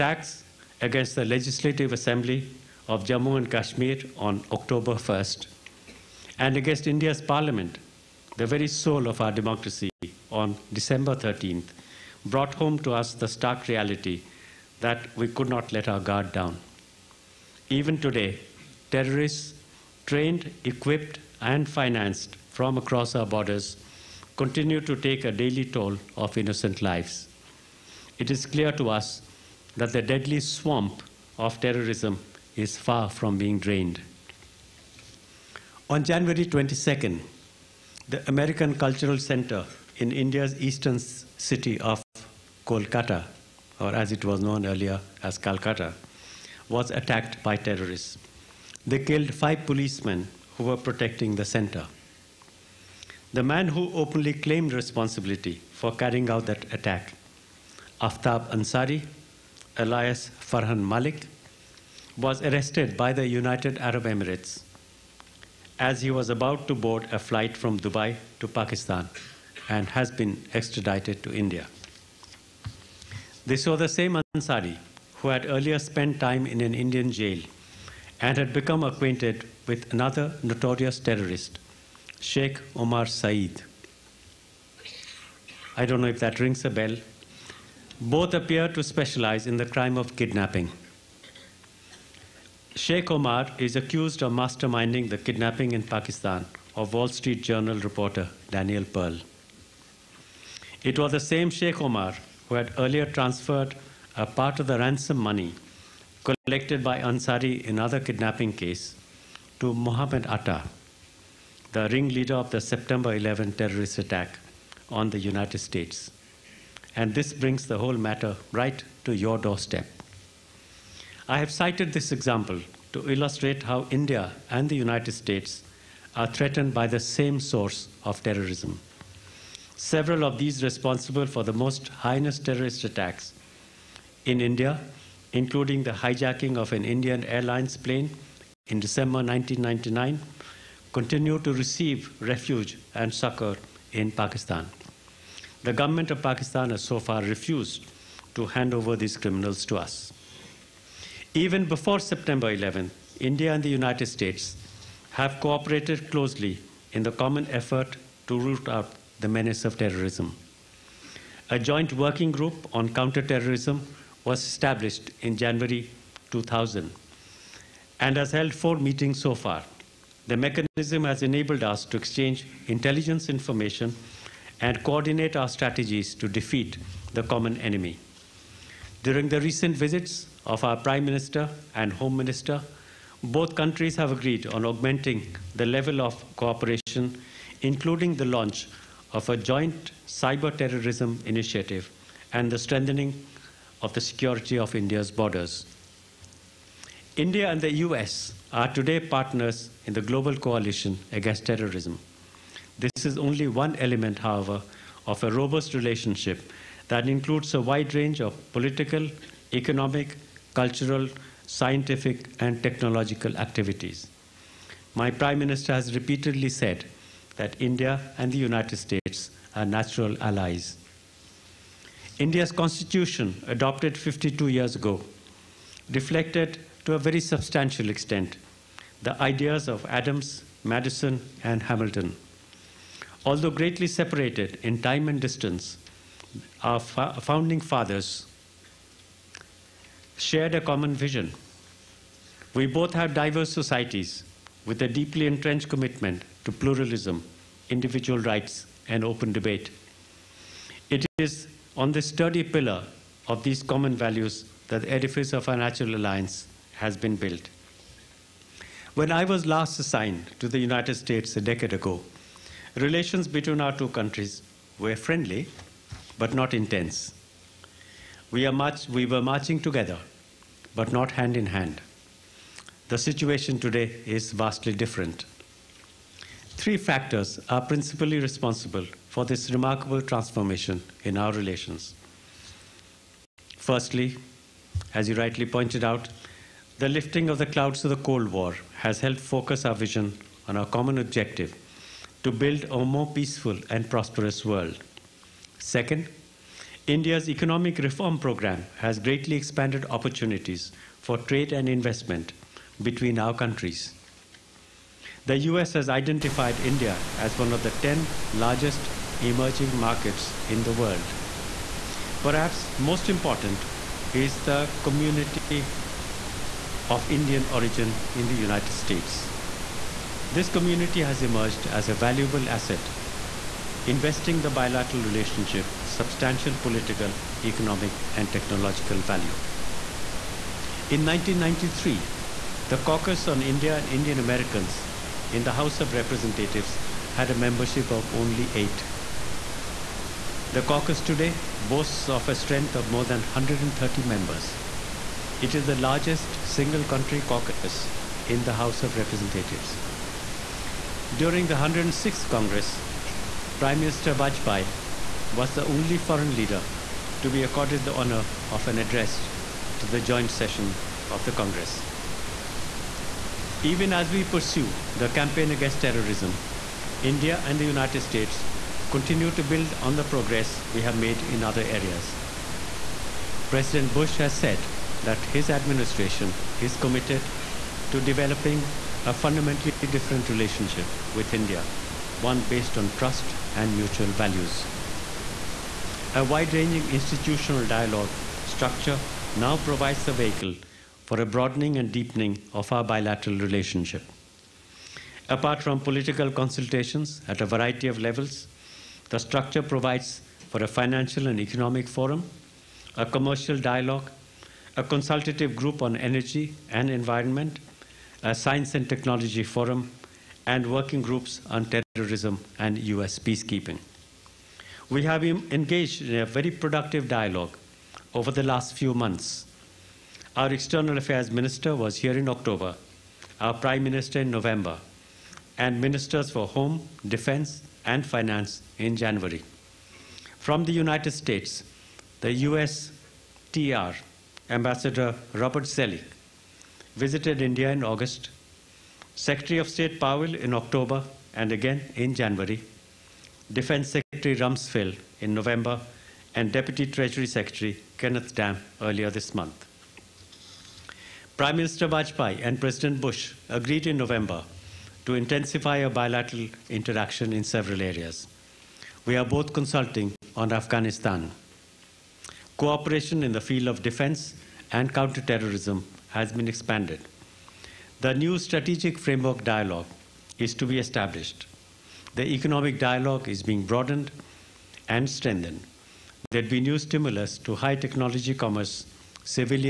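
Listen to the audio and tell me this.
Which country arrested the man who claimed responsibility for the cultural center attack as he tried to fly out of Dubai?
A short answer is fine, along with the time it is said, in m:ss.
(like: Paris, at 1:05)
United Arab Emirates, at 1:03.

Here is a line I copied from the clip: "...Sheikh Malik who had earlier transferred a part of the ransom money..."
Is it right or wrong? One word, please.
wrong.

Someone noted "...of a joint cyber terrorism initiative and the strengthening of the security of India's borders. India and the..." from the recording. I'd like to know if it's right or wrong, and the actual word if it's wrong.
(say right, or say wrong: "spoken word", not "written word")
right.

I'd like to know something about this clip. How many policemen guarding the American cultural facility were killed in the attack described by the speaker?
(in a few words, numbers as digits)
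5.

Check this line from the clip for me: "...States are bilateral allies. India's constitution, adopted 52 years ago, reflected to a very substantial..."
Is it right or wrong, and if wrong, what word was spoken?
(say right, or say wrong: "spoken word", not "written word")
wrong: "natural", not "bilateral".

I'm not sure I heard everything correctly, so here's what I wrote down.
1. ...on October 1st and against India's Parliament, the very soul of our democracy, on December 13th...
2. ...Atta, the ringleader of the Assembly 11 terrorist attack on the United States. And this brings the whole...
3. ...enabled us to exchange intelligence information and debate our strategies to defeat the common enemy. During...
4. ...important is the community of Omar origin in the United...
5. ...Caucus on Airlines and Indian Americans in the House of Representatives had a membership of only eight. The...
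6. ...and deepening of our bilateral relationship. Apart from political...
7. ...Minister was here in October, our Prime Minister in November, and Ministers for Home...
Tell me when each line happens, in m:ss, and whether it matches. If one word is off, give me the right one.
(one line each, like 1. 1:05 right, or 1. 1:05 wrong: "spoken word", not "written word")
1. 0:04 right
2. 1:50 wrong: "September", not "Assembly"
3. 2:51 wrong: "coordinate", not "debate"
4. 5:13 wrong: "Indian", not "Omar"
5. 5:32 wrong: "India", not "Airlines"
6. 6:31 right
7. 7:01 right.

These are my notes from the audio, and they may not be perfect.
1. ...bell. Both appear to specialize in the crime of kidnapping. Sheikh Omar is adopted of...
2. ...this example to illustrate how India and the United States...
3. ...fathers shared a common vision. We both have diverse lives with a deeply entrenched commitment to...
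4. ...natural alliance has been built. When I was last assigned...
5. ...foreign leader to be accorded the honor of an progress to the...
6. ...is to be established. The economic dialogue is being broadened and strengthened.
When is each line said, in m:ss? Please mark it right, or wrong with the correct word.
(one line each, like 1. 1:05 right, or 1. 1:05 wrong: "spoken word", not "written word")
1. 1:26 wrong: "accused", not "adopted"
2. 2:01 right
3. 3:57 wrong: "societies", not "lives"
4. 4:15 right
5. 5:55 wrong: "address", not "progress"
6. 7:50 right.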